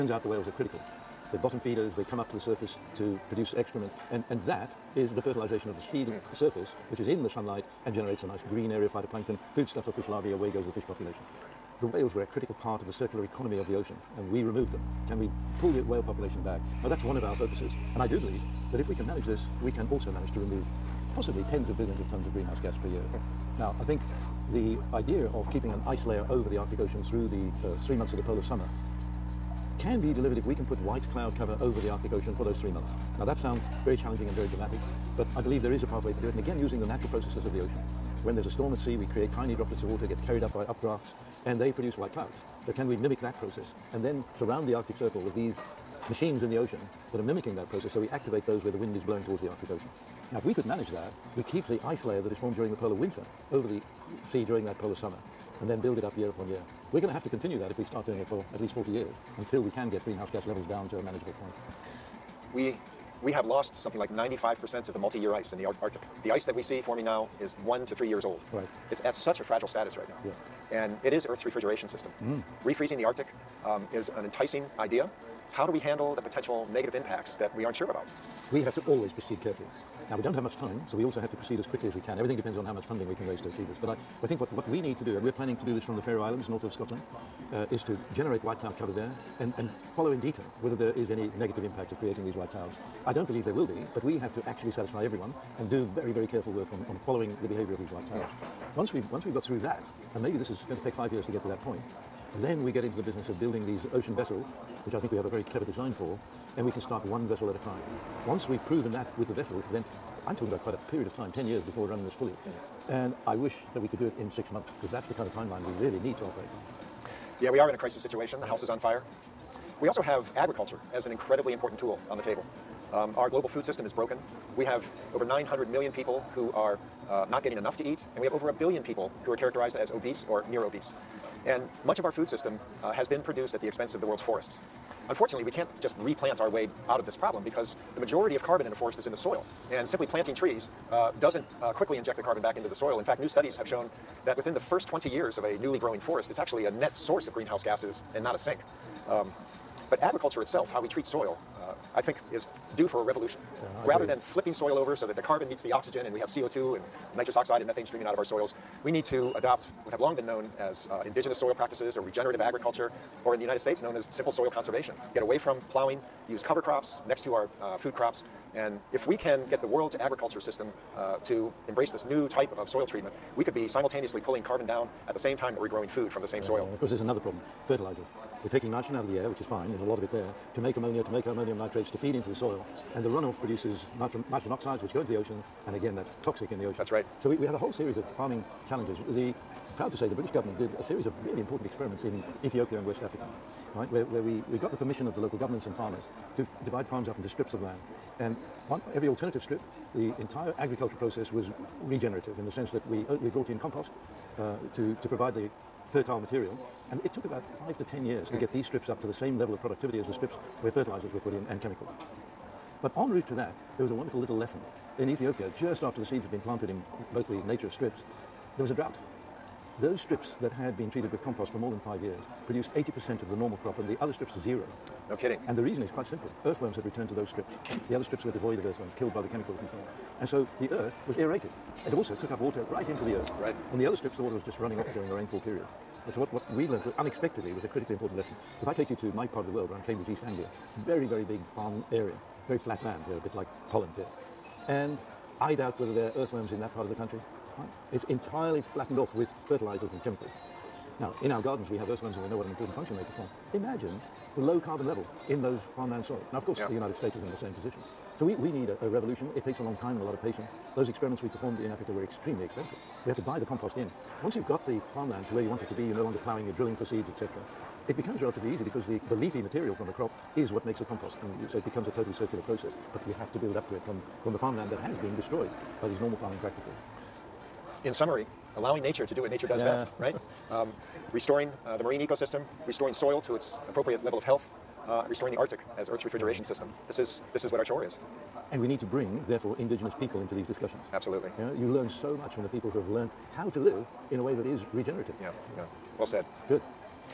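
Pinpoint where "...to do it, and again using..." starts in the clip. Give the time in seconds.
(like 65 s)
36 s.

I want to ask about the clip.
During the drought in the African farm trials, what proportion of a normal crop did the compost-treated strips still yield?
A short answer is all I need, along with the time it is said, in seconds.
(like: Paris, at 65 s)
80%, at 222 s.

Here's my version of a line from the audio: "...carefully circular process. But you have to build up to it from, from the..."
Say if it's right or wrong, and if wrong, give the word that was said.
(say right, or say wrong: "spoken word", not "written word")
wrong: "totally", not "carefully".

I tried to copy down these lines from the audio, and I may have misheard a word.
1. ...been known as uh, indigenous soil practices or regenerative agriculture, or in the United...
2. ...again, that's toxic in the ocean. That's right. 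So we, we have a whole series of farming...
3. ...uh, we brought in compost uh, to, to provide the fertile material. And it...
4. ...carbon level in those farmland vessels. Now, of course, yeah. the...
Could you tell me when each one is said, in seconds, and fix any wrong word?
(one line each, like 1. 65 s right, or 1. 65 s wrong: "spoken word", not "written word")
1. 160 s right
2. 185 s right
3. 203 s right
4. 254 s wrong: "soils", not "vessels".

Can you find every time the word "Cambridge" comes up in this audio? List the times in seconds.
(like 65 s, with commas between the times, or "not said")
239 s.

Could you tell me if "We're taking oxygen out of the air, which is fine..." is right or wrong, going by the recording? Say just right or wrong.
wrong.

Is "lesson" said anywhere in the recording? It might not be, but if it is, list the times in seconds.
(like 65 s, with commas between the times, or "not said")
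214 s, 238 s.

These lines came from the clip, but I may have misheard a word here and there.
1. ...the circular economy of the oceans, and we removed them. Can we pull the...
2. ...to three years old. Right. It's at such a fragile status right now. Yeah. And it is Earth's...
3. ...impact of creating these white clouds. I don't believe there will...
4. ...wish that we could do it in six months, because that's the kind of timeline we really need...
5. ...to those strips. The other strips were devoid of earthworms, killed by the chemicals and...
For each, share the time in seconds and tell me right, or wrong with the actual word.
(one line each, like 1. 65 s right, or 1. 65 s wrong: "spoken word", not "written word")
1. 12 s right
2. 67 s right
3. 91 s right
4. 113 s right
5. 227 s right.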